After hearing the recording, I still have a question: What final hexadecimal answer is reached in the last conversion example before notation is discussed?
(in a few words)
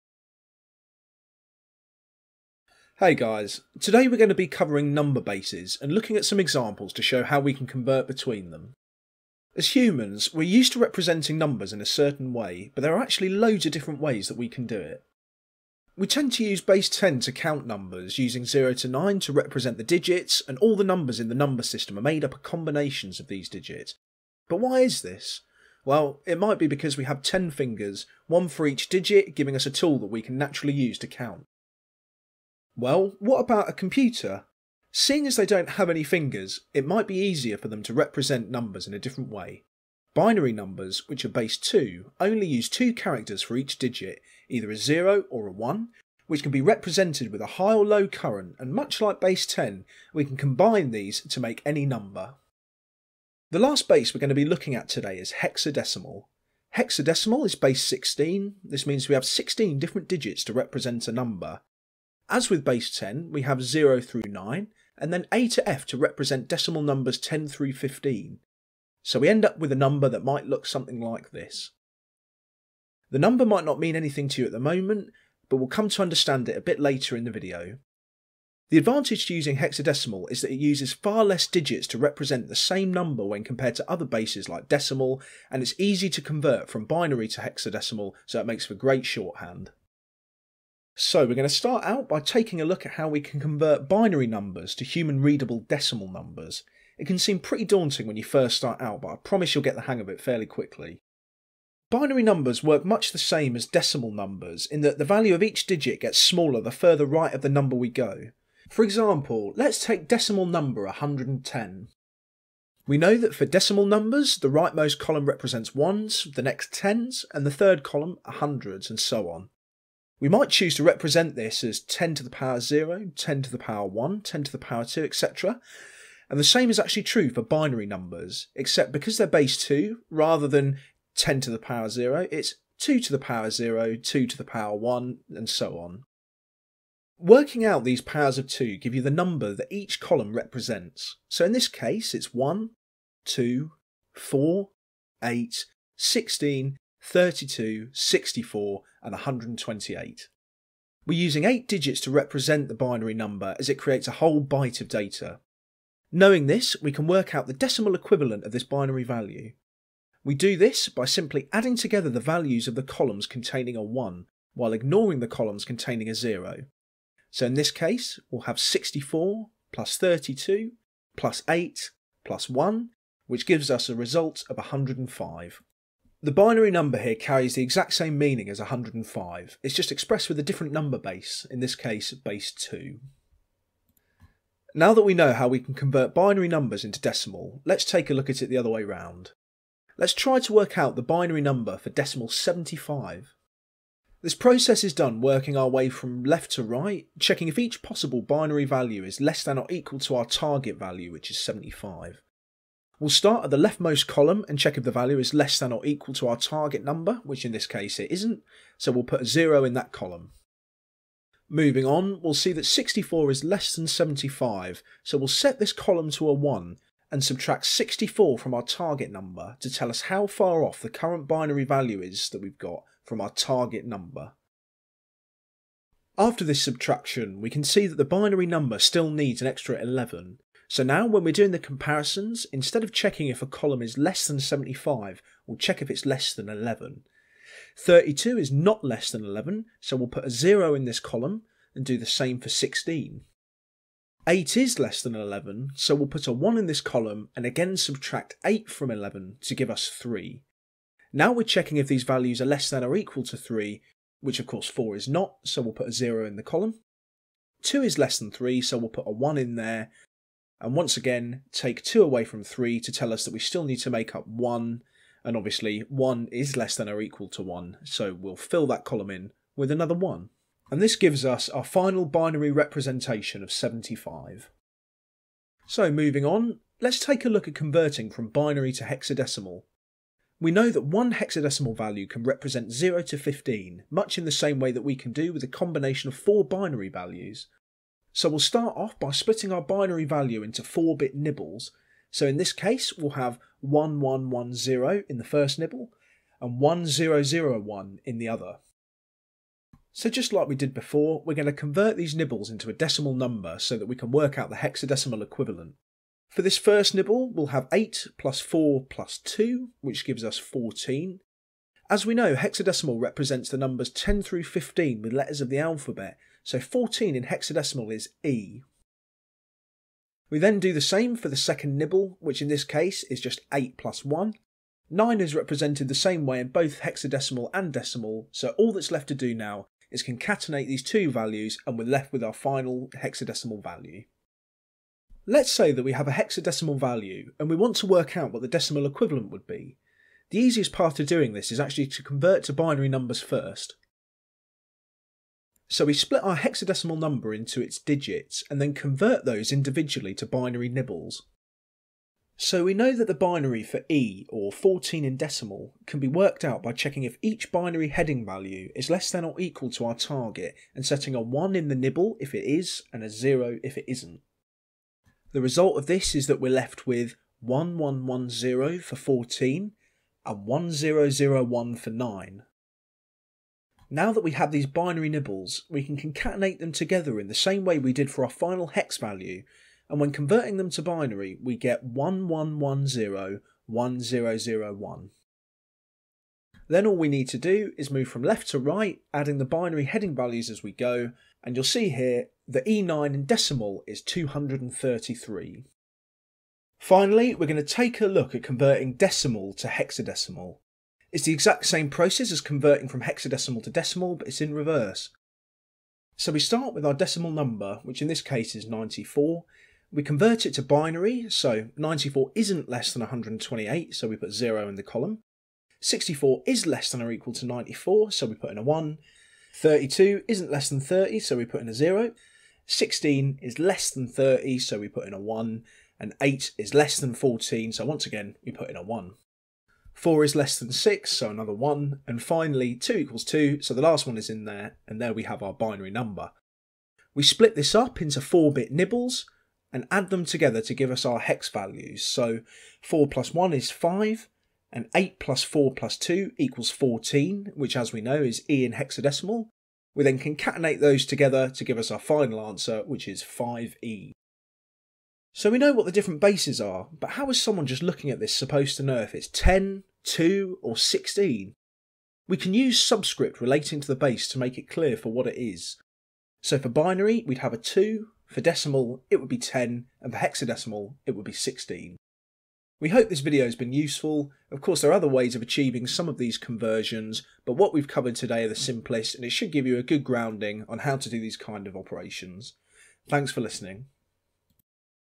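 5E.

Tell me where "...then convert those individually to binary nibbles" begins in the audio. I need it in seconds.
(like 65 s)
348 s.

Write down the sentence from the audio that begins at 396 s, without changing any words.
Finally, we're going to take a look at converting decimal to hexadecimal.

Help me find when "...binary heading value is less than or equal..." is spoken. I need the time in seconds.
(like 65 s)
357 s.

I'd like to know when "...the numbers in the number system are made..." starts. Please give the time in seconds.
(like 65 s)
20 s.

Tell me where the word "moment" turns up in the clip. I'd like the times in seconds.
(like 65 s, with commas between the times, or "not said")
74 s.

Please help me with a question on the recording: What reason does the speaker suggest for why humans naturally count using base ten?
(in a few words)
10 fingers.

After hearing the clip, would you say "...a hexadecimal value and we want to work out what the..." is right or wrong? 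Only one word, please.
right.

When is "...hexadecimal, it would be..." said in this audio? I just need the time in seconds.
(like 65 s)
470 s.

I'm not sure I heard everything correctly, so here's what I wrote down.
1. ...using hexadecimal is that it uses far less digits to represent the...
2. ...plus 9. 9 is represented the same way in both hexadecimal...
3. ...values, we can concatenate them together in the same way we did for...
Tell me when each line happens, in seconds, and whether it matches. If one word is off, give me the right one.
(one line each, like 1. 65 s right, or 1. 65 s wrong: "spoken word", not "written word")
1. 79 s right
2. 323 s wrong: "1", not "9"
3. 375 s wrong: "nibbles", not "values".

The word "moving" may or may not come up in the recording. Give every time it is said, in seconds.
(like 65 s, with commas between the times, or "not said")
211 s, 275 s.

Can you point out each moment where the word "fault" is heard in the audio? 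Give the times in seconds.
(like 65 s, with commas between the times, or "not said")
not said.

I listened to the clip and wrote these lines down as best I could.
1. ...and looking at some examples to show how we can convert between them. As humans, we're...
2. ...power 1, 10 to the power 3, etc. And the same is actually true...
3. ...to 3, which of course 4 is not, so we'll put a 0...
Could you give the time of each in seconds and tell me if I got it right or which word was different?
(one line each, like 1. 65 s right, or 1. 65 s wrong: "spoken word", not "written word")
1. 5 s right
2. 123 s wrong: "2", not "3"
3. 253 s right.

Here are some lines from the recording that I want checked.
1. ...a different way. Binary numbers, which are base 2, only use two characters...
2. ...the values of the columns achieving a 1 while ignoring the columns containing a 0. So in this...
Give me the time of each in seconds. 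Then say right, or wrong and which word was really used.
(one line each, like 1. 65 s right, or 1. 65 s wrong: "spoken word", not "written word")
1. 38 s right
2. 162 s wrong: "containing", not "achieving".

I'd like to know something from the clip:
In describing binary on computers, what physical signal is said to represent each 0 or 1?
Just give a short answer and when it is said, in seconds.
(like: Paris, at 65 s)
high or low current, at 47 s.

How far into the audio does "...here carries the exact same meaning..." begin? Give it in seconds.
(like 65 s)
176 s.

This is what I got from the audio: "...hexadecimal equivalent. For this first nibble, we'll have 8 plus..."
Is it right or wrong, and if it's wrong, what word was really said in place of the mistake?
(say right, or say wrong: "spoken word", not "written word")
right.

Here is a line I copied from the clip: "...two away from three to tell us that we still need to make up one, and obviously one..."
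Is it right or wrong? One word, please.
right.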